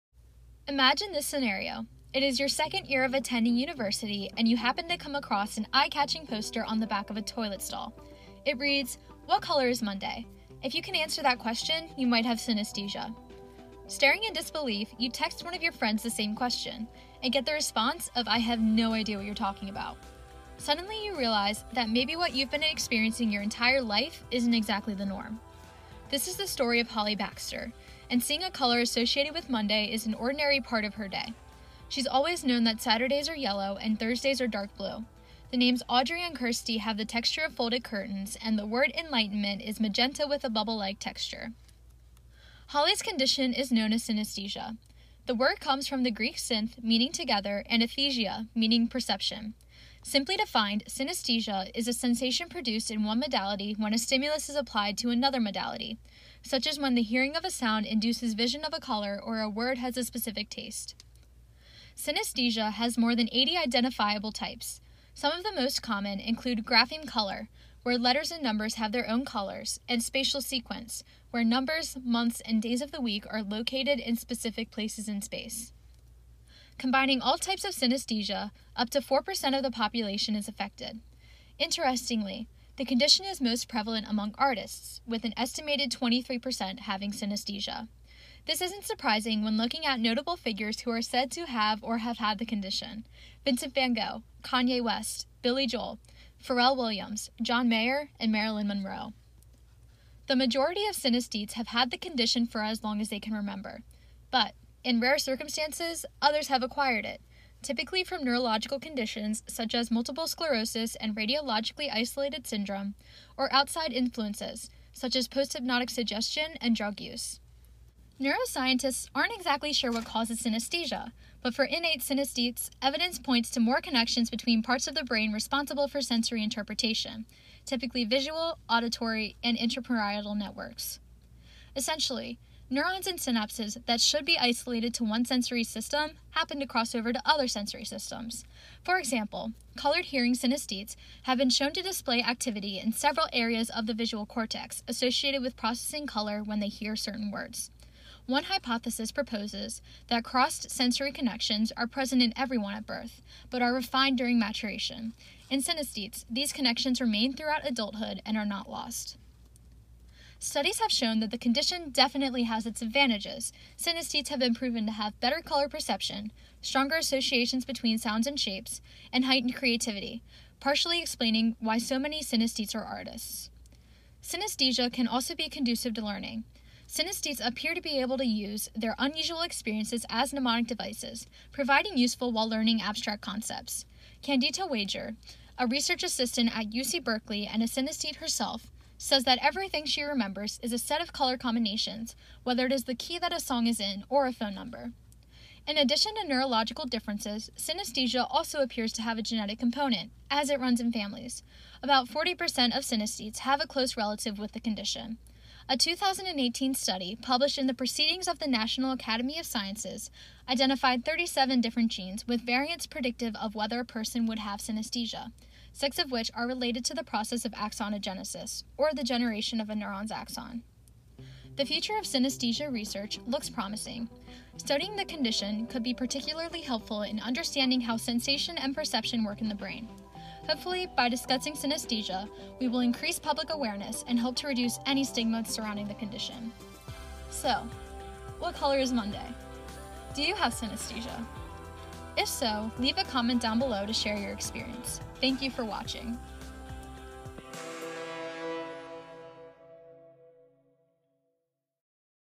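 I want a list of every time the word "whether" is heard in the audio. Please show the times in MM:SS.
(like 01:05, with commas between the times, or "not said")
03:12, 03:33.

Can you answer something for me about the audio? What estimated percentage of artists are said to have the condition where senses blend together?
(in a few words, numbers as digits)
23%.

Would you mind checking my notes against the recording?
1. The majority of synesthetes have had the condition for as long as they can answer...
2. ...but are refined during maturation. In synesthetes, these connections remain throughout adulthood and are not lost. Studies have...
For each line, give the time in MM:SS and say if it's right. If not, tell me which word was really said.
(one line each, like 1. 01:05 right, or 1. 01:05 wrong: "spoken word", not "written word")
1. 01:40 wrong: "remember", not "answer"
2. 02:33 right.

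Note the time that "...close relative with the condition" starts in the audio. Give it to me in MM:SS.
03:23.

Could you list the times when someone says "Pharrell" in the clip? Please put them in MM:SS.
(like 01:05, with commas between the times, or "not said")
01:36.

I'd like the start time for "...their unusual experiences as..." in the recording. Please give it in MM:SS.
02:58.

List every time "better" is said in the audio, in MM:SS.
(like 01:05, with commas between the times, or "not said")
02:45.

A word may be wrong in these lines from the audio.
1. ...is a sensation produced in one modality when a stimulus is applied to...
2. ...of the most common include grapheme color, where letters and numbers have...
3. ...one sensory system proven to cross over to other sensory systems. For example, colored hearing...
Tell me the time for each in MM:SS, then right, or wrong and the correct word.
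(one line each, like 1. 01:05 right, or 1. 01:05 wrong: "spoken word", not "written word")
1. 00:51 right
2. 01:05 right
3. 02:15 wrong: "happen", not "proven".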